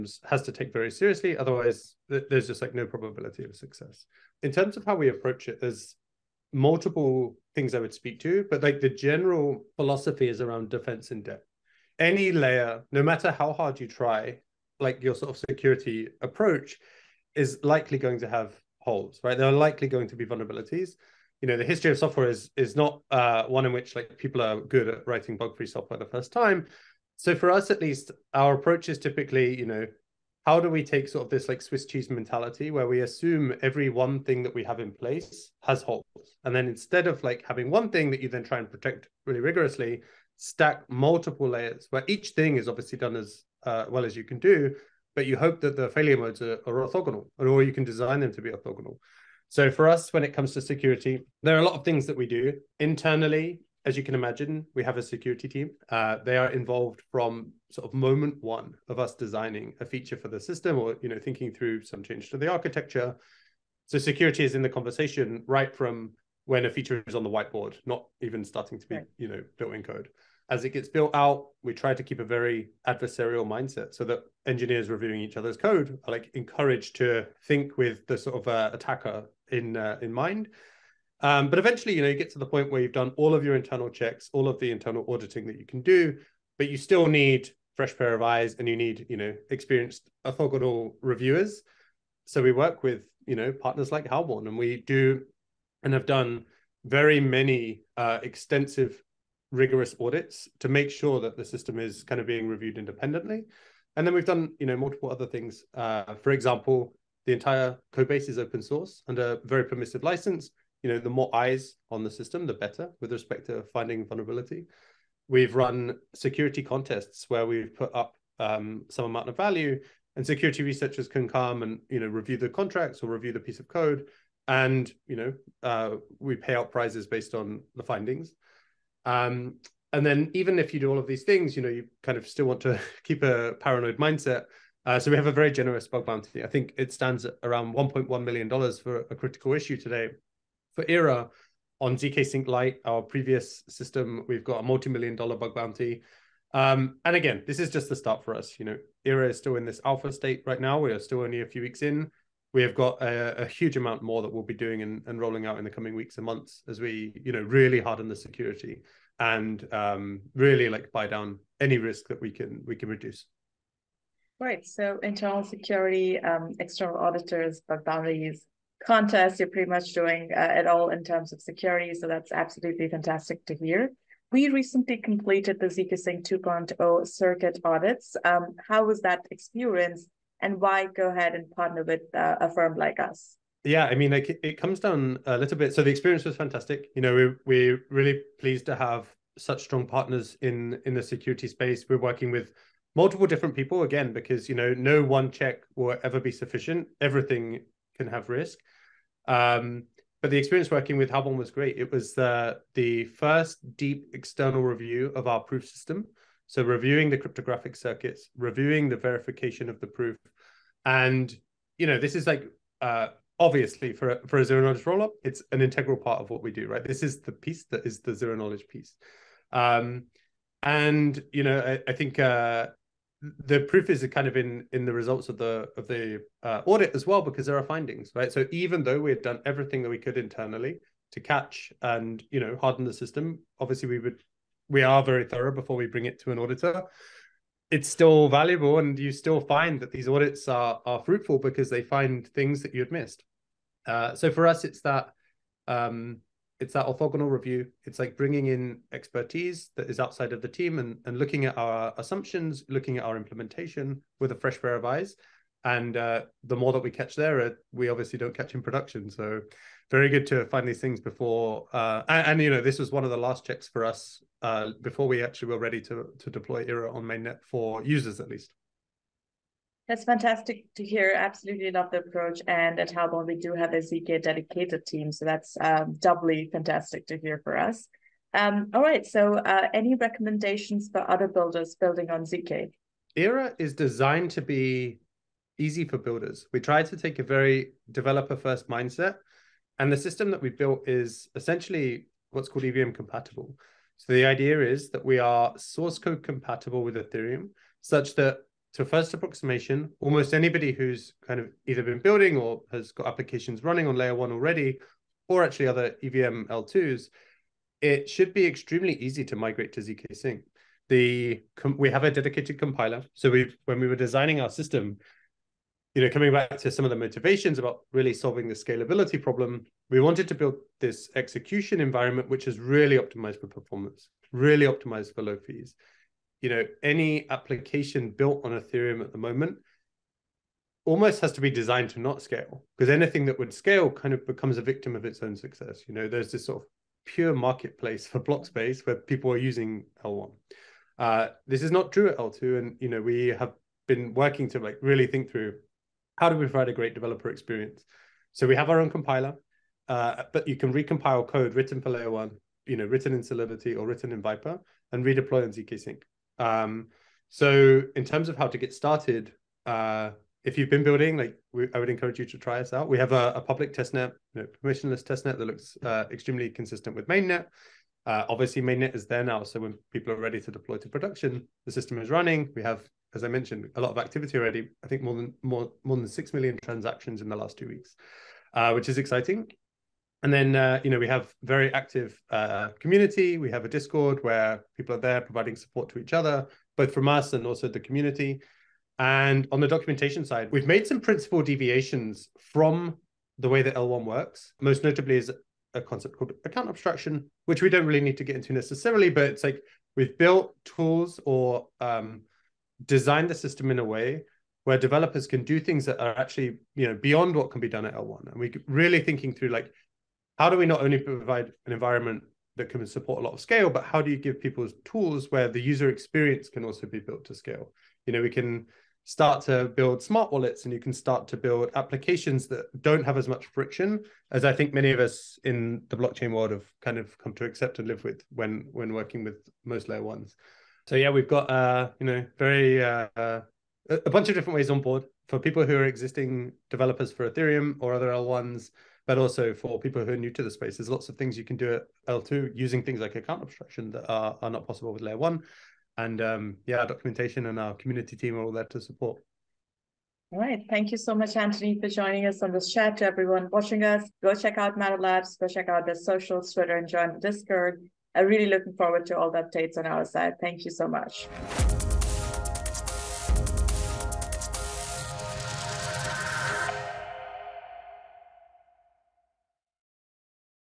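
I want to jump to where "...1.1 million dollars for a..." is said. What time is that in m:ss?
2:17.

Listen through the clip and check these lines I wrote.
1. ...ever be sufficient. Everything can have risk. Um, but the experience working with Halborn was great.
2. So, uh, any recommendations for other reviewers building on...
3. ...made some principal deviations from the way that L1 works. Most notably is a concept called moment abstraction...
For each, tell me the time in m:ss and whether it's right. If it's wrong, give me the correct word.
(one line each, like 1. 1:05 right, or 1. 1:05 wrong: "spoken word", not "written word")
1. 3:16 right
2. 4:39 wrong: "builders", not "reviewers"
3. 6:30 wrong: "account", not "moment".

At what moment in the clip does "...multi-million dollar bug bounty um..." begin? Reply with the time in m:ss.
2:24.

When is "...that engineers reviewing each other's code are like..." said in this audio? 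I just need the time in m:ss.
1:14.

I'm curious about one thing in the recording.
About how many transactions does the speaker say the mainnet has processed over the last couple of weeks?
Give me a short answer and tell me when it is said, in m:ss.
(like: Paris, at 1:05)
6 million, at 6:16.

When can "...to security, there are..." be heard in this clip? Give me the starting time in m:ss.
0:50.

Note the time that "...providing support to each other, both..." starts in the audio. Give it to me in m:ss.
6:25.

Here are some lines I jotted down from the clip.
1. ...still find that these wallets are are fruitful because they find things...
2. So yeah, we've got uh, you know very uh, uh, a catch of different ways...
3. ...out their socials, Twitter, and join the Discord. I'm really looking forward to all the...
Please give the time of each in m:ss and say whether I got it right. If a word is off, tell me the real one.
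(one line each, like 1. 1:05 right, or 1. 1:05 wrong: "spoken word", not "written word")
1. 3:59 wrong: "audits", not "wallets"
2. 7:10 wrong: "bunch", not "catch"
3. 7:35 right.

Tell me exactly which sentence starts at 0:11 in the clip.
Any layer, no matter how hard you try, like your sort of security approach, is likely going to have holes, right?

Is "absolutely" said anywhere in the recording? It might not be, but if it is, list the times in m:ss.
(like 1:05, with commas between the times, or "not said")
2:52, 4:31.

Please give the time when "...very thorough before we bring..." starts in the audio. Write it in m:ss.
3:55.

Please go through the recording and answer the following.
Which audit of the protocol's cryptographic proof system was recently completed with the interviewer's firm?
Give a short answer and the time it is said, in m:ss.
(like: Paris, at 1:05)
zkSync 2.0 circuit audits, at 2:55.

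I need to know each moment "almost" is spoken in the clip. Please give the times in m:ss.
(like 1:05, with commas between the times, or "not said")
4:59, 5:30.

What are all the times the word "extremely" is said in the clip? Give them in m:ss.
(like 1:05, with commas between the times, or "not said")
5:08, 6:06.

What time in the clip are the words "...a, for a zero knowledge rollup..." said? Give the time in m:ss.
3:34.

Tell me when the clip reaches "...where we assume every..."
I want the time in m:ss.
0:32.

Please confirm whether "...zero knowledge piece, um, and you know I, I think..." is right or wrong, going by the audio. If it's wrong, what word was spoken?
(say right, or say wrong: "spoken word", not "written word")
right.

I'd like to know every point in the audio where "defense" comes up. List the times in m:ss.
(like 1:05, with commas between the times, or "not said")
0:10.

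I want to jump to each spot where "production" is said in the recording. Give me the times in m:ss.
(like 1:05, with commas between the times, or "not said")
4:18, 6:10.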